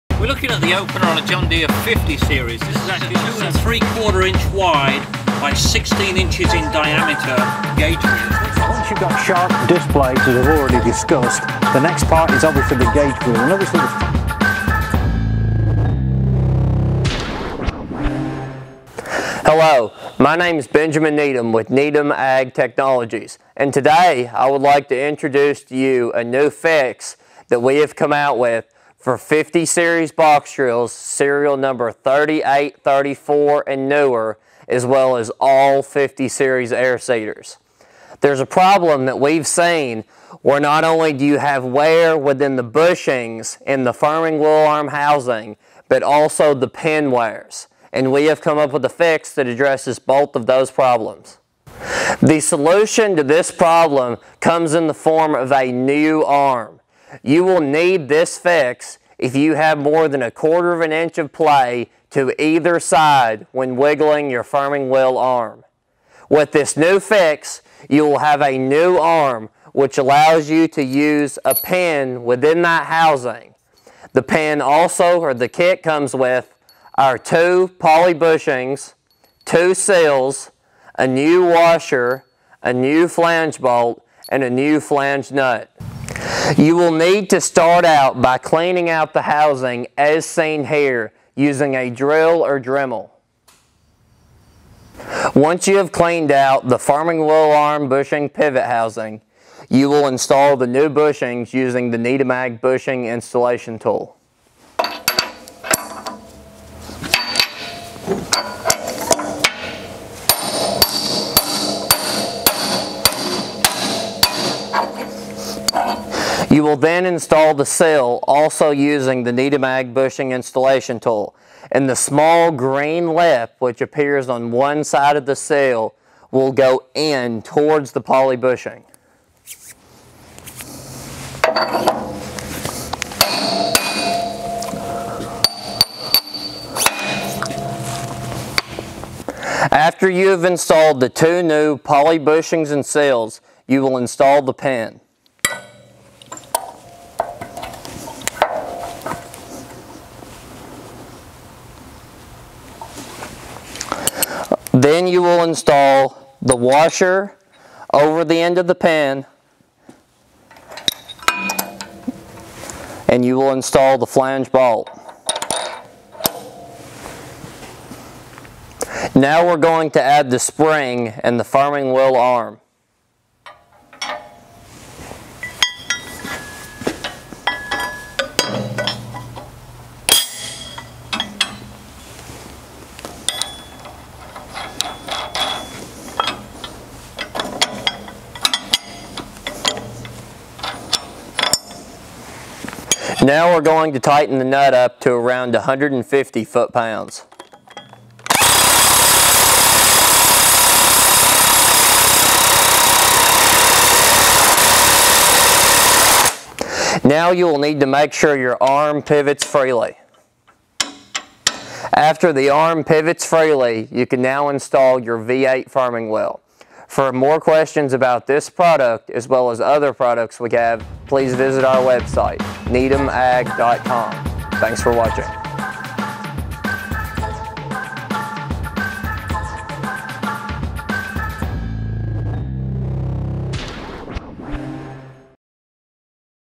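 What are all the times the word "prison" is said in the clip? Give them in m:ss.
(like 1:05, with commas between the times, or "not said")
not said.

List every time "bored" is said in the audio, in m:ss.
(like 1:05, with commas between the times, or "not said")
not said.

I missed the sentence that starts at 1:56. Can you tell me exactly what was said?
You will then install the seal also using the Needham Ag bushing installation tool.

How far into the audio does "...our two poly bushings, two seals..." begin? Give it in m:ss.
1:16.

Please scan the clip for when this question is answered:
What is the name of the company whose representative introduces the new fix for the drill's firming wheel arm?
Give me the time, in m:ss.
0:21.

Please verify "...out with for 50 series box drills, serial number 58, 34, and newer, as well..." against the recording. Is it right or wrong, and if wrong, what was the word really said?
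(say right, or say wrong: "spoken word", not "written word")
wrong: "38", not "58".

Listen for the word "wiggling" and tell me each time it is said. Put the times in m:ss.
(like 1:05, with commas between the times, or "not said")
1:03.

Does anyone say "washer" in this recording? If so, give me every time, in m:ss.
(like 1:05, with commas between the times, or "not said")
1:21, 2:36.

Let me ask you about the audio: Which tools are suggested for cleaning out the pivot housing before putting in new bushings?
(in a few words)
drill or Dremel.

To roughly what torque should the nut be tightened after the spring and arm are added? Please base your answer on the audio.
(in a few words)
150 foot-pounds.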